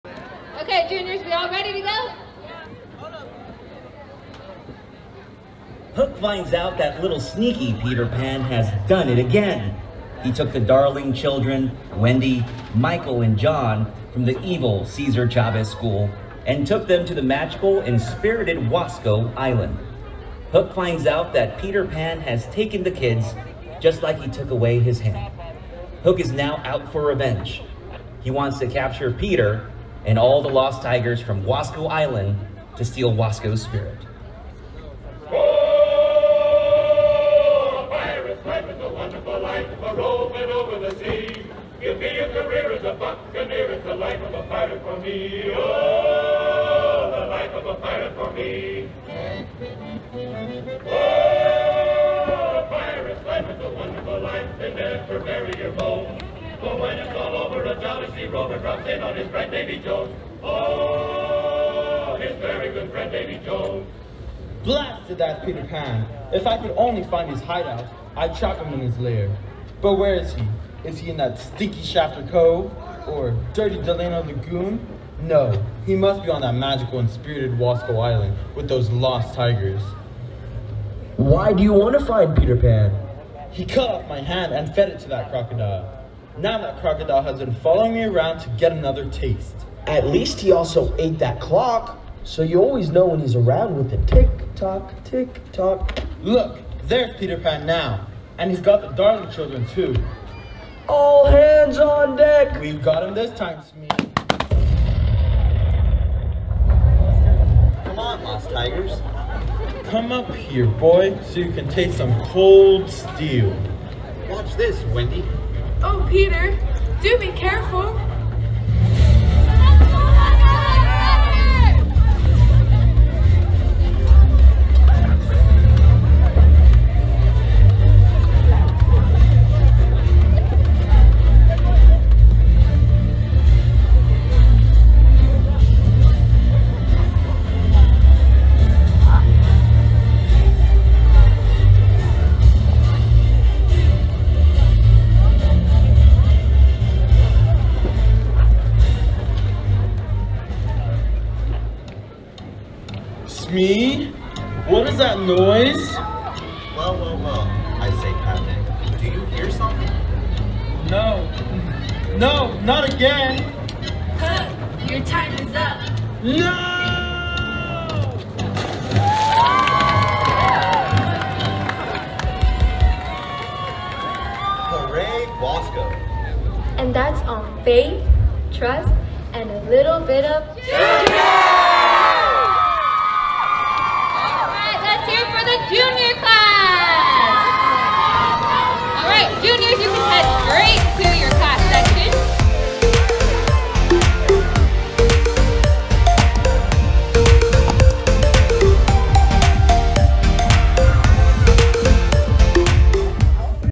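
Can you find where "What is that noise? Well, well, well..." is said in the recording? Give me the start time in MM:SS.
02:34.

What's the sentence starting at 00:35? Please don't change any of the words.
Oh, pirates, a wonderful life, a rolling over the sea.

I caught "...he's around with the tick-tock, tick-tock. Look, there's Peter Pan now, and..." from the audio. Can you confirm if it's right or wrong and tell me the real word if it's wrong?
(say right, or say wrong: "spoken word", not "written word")
right.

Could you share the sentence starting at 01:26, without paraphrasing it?
Now that crocodile has been following me around to get another taste.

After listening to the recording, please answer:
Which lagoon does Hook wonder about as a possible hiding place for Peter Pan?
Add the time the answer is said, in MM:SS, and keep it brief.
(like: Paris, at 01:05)
Delano Lagoon, at 01:13.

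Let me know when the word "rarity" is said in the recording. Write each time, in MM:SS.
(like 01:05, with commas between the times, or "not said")
not said.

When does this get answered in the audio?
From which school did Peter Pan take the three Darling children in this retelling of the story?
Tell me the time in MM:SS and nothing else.
00:14.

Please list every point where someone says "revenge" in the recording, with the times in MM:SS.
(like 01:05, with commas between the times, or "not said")
00:27.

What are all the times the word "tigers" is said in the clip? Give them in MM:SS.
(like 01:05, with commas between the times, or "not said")
00:30, 01:19, 01:48.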